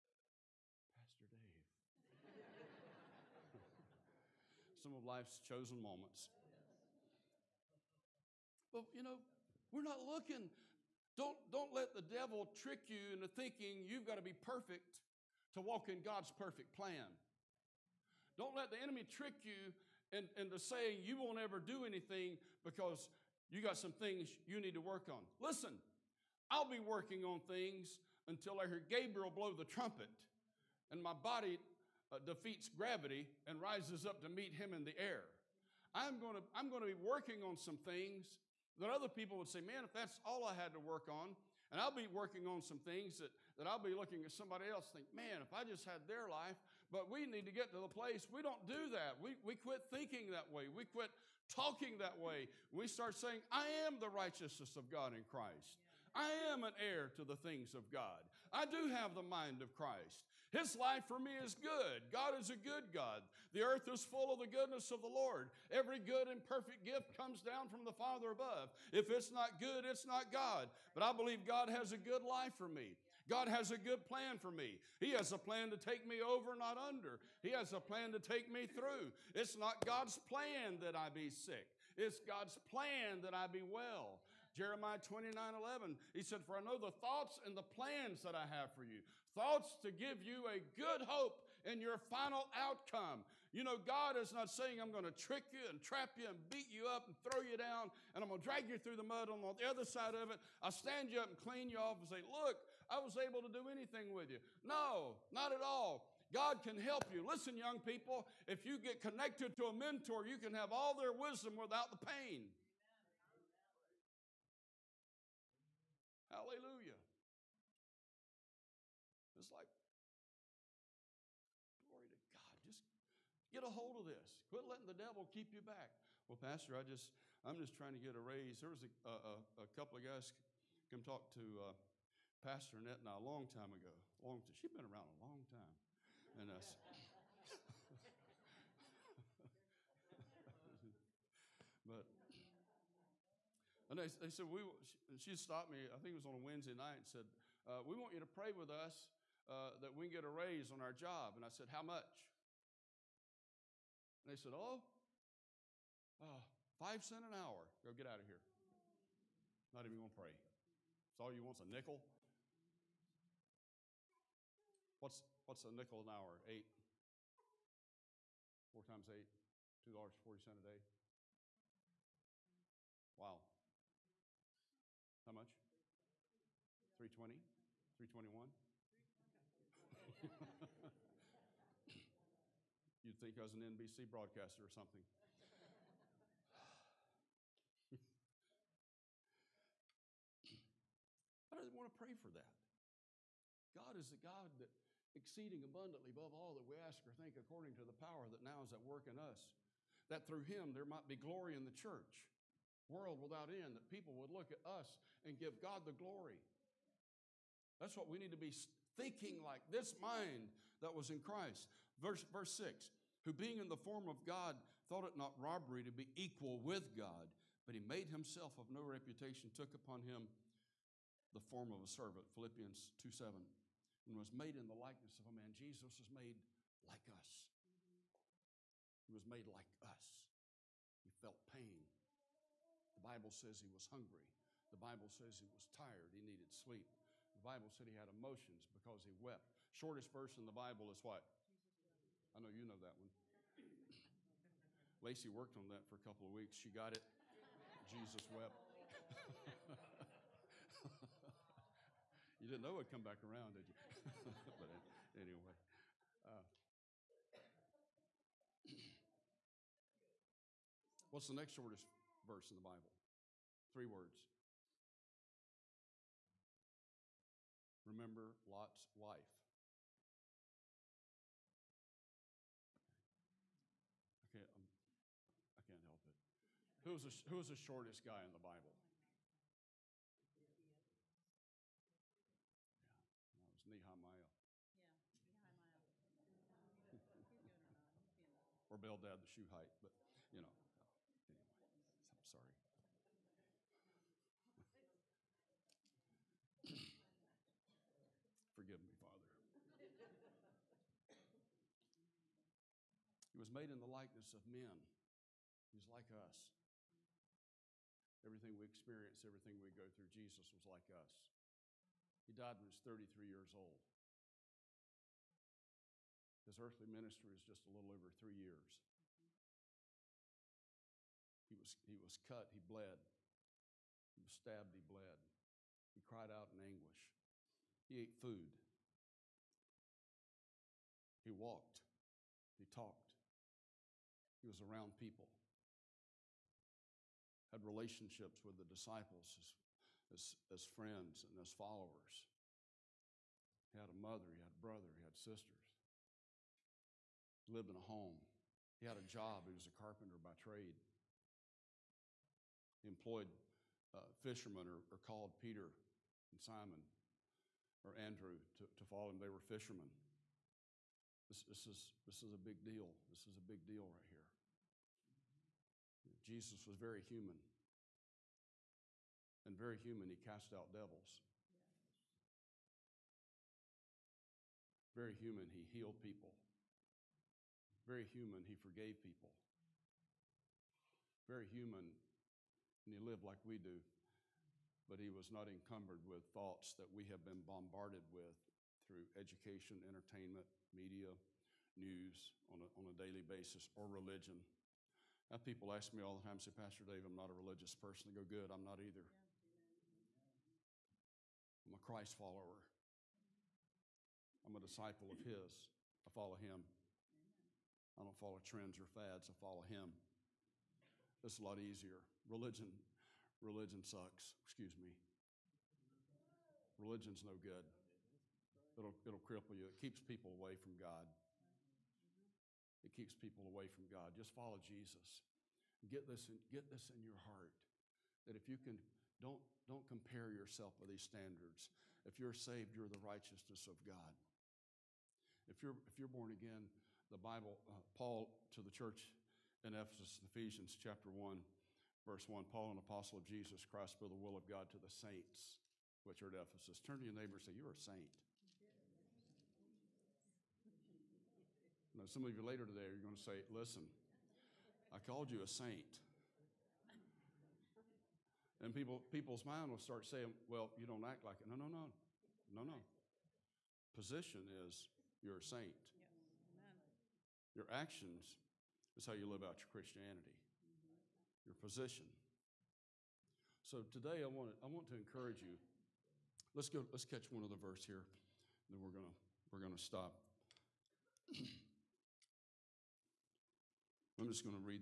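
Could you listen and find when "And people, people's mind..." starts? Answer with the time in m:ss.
7:38.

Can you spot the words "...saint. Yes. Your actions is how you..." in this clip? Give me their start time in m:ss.
7:45.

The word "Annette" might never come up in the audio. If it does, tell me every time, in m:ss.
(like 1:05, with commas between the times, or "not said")
2:12.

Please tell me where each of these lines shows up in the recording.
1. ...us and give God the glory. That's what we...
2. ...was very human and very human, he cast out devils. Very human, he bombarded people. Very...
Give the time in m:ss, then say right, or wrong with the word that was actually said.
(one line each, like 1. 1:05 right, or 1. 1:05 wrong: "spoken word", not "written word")
1. 3:24 right
2. 6:06 wrong: "healed", not "bombarded".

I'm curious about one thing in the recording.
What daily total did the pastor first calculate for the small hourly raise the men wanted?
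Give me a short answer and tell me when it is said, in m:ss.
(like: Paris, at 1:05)
$2.40, at 2:49.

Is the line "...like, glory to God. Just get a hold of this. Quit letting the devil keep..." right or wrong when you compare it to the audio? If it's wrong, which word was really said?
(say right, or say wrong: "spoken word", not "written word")
right.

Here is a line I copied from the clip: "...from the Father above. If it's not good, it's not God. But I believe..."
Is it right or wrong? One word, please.
right.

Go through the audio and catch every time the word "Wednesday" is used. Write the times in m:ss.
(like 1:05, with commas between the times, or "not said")
2:26.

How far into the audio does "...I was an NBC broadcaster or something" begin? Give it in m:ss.
3:03.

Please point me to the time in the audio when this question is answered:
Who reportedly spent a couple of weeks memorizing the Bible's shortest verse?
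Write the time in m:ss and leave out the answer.
4:05.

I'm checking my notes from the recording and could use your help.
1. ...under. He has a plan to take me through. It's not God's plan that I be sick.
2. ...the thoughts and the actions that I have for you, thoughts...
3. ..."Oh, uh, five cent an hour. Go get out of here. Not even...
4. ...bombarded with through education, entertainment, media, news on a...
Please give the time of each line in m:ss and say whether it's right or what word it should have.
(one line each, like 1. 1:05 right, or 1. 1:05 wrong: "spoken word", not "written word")
1. 1:16 right
2. 1:26 wrong: "plans", not "actions"
3. 2:34 right
4. 6:27 right.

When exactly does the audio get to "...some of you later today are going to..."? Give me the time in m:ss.
7:32.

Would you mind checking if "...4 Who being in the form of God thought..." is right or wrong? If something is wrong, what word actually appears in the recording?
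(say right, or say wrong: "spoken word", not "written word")
wrong: "6", not "4".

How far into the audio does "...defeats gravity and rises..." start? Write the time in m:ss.
0:32.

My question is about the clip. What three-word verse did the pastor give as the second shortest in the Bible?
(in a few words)
Remember Lot's wife.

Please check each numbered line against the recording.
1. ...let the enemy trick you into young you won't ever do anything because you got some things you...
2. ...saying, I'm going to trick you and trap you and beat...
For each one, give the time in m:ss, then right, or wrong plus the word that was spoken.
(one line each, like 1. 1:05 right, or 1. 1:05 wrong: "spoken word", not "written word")
1. 0:18 wrong: "saying", not "young"
2. 1:34 right.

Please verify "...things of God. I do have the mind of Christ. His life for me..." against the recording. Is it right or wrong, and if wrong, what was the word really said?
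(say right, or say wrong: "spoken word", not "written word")
right.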